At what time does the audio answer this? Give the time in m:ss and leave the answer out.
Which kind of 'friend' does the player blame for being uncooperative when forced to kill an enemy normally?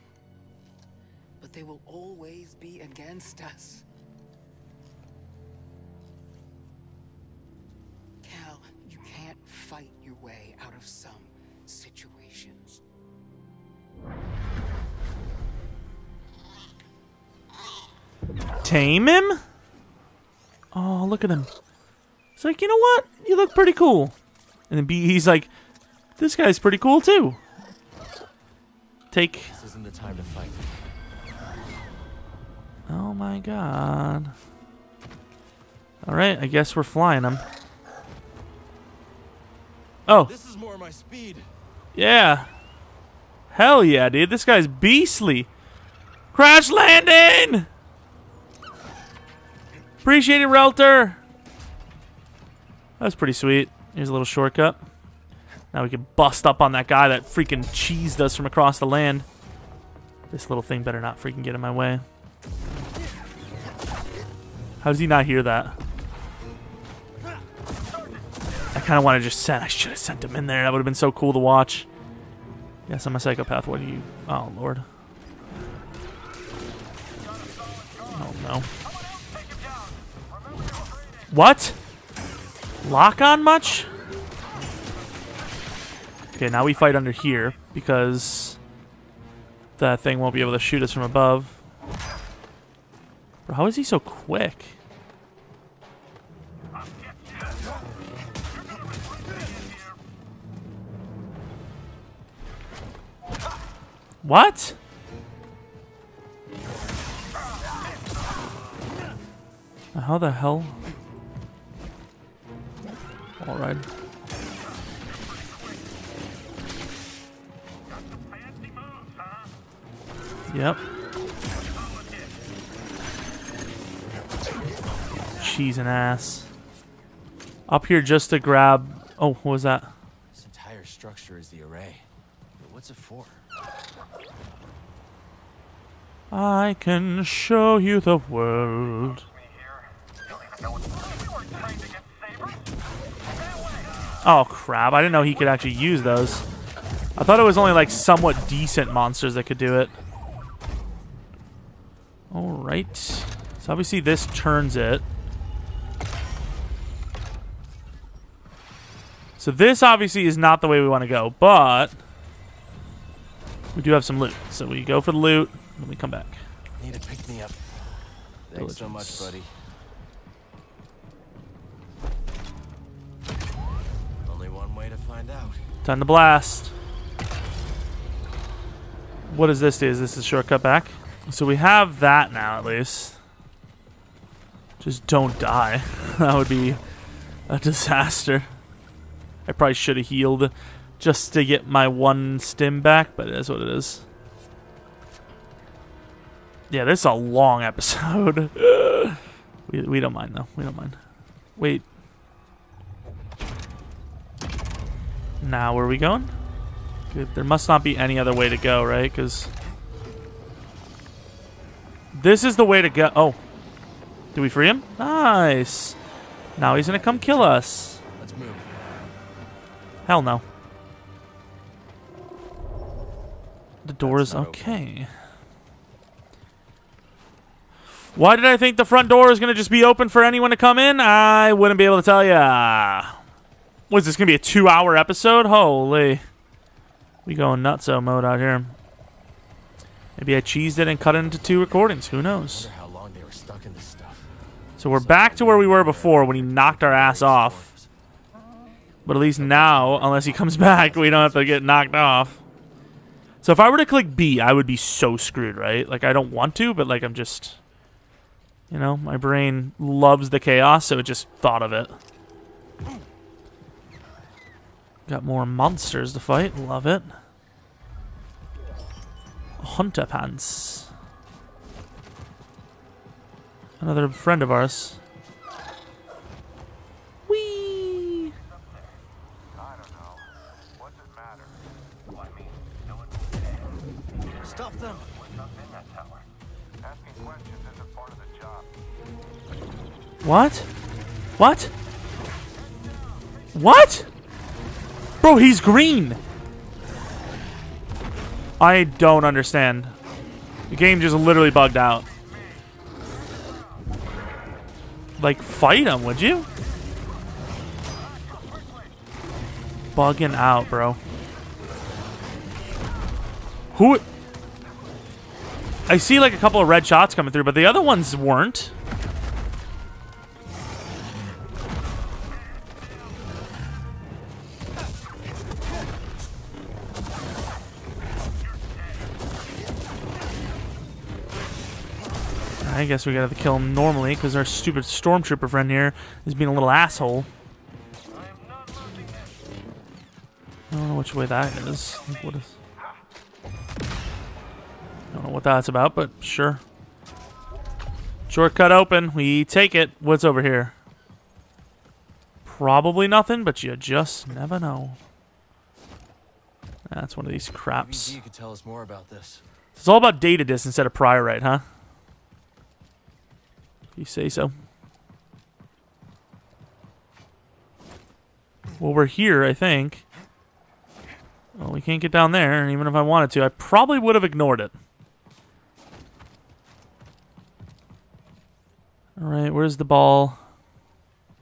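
5:34.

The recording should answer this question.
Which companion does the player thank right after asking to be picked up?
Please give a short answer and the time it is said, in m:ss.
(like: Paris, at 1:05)
Diligence, at 2:48.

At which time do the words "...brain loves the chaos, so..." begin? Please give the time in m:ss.
4:19.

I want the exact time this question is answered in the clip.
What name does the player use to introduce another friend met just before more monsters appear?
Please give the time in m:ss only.
4:29.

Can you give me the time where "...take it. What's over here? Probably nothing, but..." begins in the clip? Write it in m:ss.
5:49.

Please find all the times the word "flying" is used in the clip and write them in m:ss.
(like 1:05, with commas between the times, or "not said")
0:36.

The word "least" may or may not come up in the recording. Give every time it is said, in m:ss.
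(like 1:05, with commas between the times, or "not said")
3:02, 4:09.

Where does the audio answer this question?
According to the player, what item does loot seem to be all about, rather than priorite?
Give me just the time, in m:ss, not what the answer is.
6:00.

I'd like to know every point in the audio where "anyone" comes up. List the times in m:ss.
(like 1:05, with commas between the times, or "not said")
3:50.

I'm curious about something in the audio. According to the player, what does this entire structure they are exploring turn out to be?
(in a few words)
the array.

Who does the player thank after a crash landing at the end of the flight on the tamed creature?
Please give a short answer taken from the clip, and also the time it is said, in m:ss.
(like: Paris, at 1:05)
Relter, at 0:50.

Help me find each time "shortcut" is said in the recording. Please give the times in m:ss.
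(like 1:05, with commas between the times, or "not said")
0:54, 3:00, 5:48.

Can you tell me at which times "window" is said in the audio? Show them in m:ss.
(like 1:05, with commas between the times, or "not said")
not said.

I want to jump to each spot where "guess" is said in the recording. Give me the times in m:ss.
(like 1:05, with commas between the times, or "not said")
0:36, 5:32.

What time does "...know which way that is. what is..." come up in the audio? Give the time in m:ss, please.
5:40.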